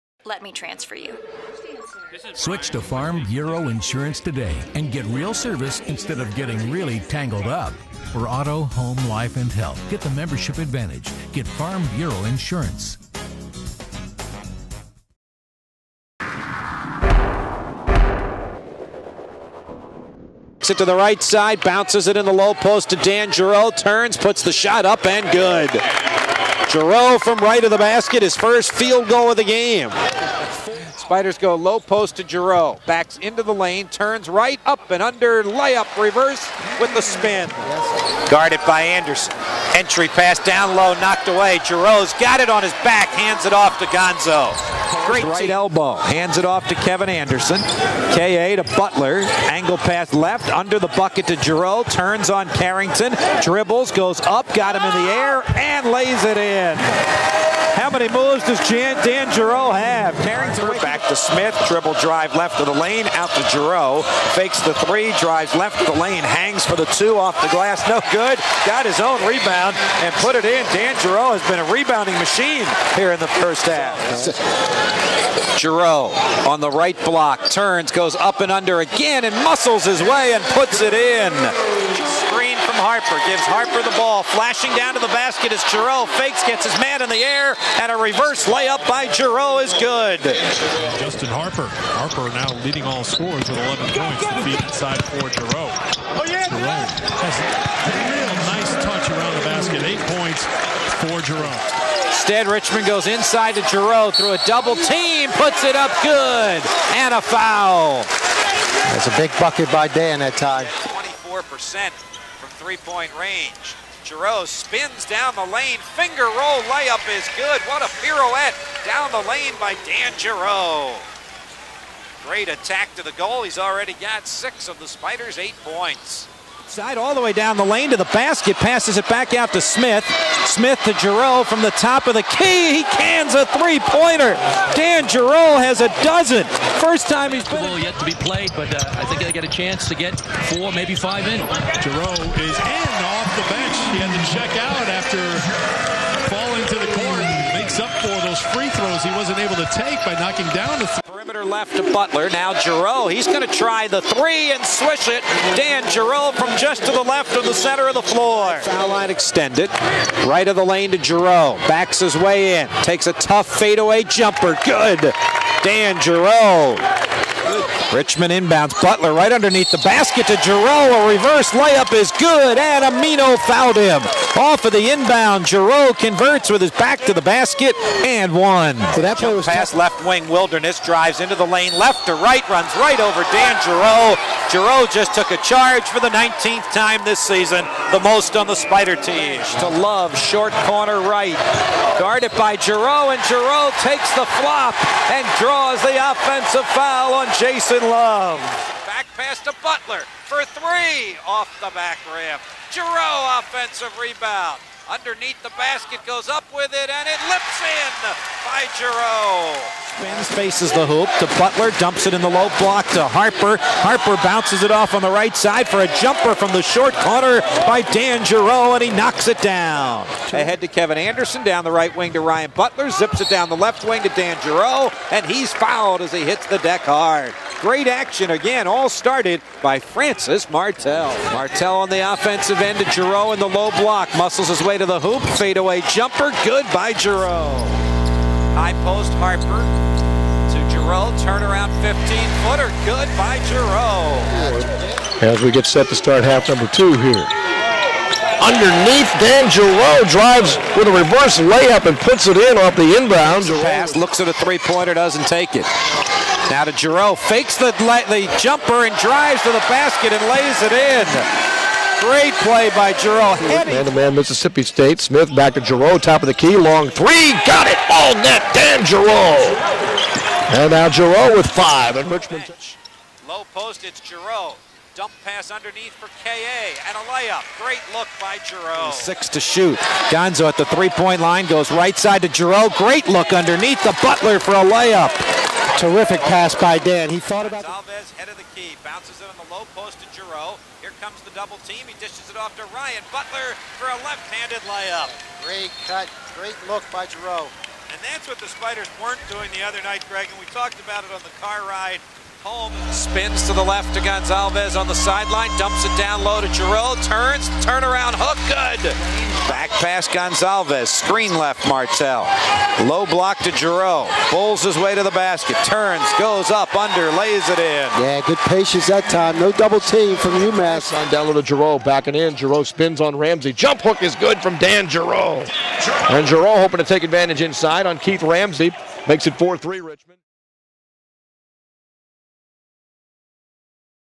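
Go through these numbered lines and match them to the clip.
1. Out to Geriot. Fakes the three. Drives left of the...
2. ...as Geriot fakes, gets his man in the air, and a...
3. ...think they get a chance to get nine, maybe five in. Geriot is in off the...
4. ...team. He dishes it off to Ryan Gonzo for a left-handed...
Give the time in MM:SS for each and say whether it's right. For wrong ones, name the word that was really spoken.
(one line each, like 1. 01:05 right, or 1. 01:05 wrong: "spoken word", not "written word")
1. 01:03 right
2. 01:25 right
3. 02:19 wrong: "four", not "nine"
4. 04:51 wrong: "Butler", not "Gonzo".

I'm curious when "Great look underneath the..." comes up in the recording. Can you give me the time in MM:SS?
04:42.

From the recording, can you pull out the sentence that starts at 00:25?
Geriot from right of the basket, his first field goal of the game.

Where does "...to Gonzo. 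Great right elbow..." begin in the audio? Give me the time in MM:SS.
00:43.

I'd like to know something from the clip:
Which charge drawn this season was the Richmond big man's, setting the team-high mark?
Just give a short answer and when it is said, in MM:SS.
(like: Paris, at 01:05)
19th, at 03:06.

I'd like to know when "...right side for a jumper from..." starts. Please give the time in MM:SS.
03:35.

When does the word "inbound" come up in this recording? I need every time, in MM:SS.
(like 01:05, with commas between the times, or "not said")
02:48, 02:54, 04:12.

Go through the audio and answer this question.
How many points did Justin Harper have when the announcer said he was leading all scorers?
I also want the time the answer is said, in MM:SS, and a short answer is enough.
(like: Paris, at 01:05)
11, at 01:33.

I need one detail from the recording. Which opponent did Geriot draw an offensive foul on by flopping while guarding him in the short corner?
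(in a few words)
Jason Love.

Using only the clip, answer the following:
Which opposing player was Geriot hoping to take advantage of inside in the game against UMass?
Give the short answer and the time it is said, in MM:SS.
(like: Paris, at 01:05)
Keith Ramsey, at 05:27.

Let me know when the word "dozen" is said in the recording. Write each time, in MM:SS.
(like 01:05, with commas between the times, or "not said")
02:16.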